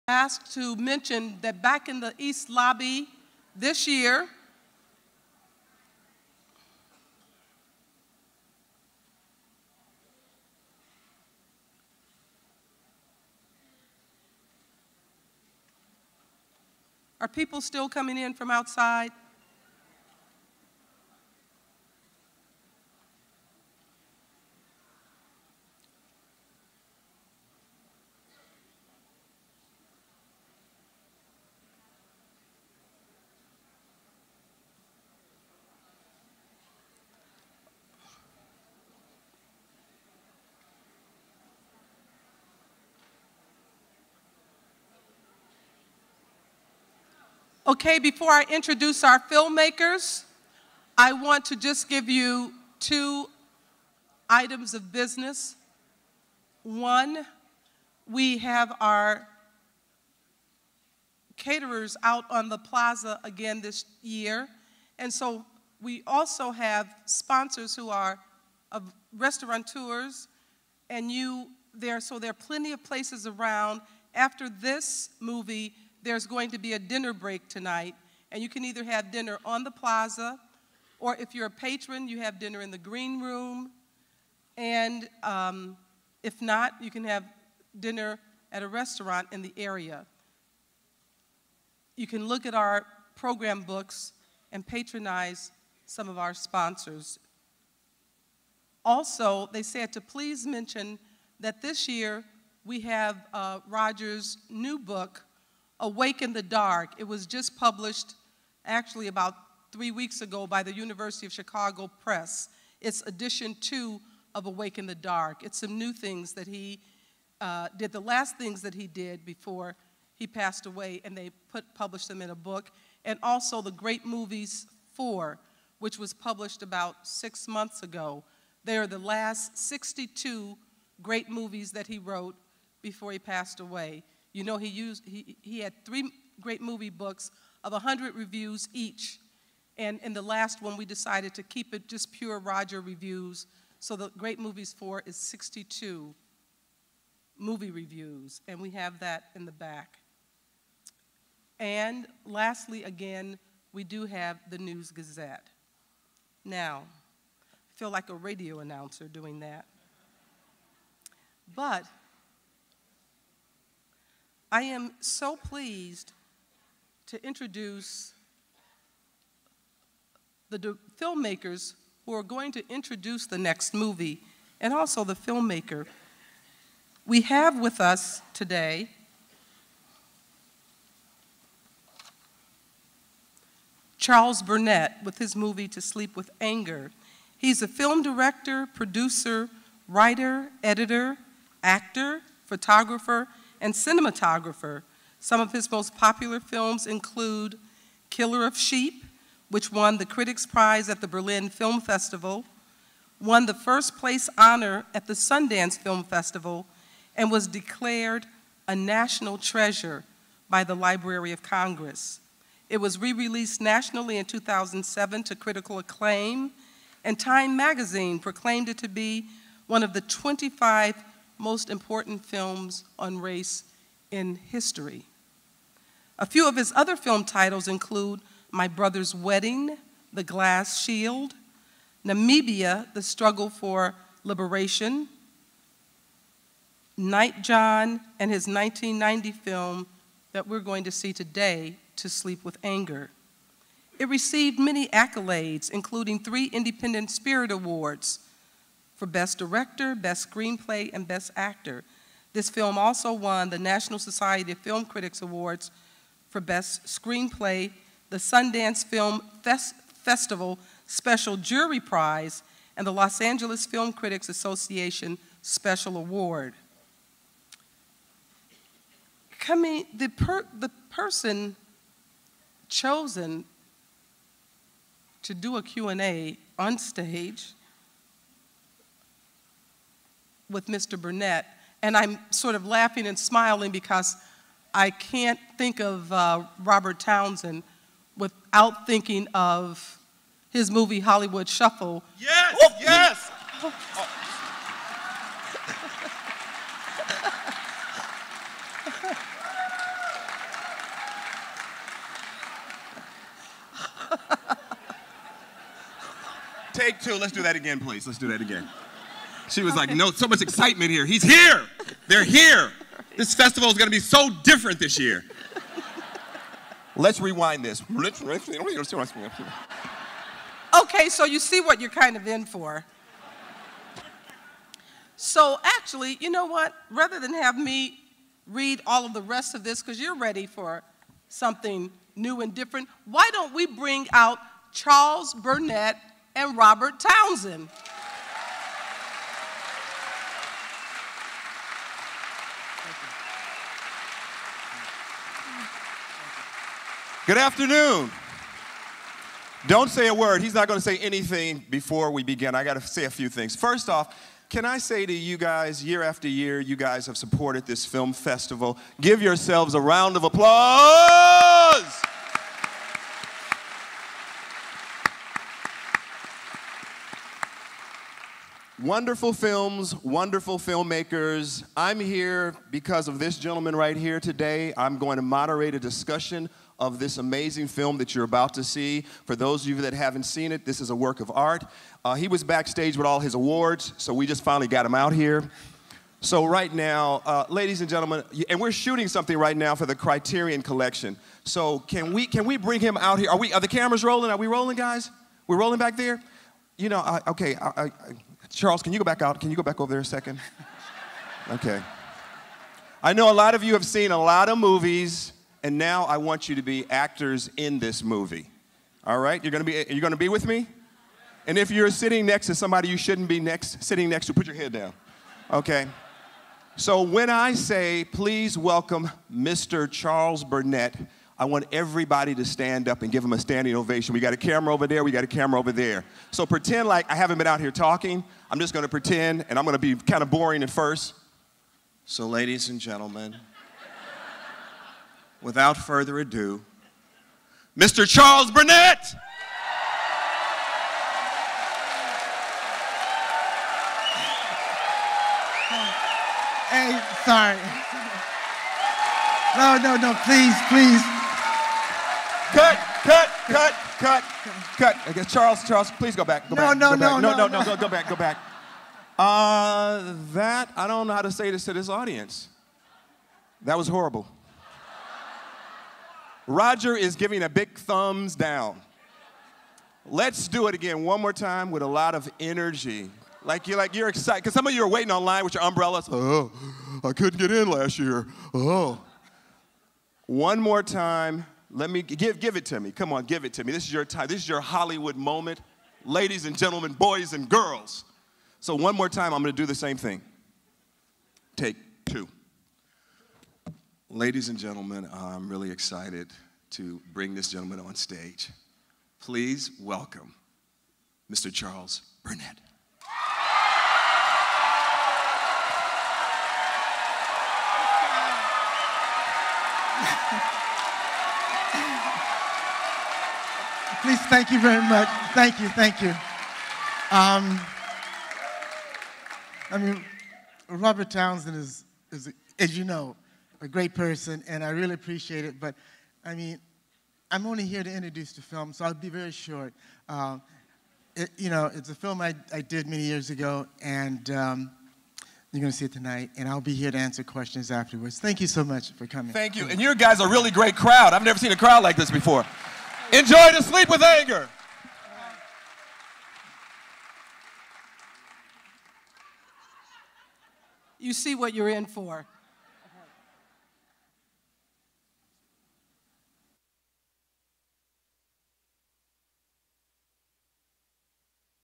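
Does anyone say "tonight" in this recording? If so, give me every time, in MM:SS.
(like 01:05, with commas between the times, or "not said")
01:17, 08:55.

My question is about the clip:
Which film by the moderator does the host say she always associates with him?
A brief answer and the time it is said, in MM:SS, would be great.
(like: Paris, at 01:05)
Hollywood Shuffle, at 04:50.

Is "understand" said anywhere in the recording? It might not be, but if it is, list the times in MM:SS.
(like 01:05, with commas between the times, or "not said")
not said.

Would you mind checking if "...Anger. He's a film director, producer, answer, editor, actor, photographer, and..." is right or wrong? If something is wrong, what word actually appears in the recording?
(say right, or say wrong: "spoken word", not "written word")
wrong: "writer", not "answer".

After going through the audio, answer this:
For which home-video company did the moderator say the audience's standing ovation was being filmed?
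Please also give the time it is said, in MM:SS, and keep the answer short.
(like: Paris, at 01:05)
Criterion Collection, at 06:29.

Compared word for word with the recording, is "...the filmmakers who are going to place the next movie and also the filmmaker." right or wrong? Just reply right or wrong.
wrong.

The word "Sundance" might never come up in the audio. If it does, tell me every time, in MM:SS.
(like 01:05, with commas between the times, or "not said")
03:25, 04:18.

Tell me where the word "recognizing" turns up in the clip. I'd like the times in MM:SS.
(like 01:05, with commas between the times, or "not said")
not said.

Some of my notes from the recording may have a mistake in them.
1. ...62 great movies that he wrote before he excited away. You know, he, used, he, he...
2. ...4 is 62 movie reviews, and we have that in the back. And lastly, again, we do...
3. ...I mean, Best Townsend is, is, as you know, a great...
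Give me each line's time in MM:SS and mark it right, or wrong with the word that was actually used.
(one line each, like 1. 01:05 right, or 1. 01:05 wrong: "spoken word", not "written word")
1. 02:09 wrong: "passed", not "excited"
2. 02:24 right
3. 08:39 wrong: "Robert", not "Best".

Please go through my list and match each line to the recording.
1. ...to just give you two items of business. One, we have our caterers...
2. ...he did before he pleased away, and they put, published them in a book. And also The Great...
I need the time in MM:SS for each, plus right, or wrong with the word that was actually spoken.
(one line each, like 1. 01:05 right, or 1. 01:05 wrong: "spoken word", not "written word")
1. 00:51 right
2. 01:58 wrong: "passed", not "pleased".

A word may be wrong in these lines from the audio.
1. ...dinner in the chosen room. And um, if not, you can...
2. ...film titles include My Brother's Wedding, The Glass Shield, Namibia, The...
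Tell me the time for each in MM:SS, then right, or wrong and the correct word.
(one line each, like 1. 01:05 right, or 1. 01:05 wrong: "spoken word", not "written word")
1. 01:22 wrong: "green", not "chosen"
2. 03:46 right.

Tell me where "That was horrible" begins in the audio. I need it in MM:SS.
07:43.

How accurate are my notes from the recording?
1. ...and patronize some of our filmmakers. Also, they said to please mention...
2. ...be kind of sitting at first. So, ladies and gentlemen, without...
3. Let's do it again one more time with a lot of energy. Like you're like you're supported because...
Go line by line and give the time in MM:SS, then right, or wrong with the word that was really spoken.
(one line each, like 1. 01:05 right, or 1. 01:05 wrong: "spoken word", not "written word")
1. 01:34 wrong: "sponsors", not "filmmakers"
2. 07:09 wrong: "boring", not "sitting"
3. 07:50 wrong: "excited", not "supported".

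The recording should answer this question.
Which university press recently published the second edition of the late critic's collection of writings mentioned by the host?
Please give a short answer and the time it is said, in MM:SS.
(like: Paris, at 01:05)
University of Chicago Press, at 01:50.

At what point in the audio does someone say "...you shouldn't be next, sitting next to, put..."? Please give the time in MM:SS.
06:52.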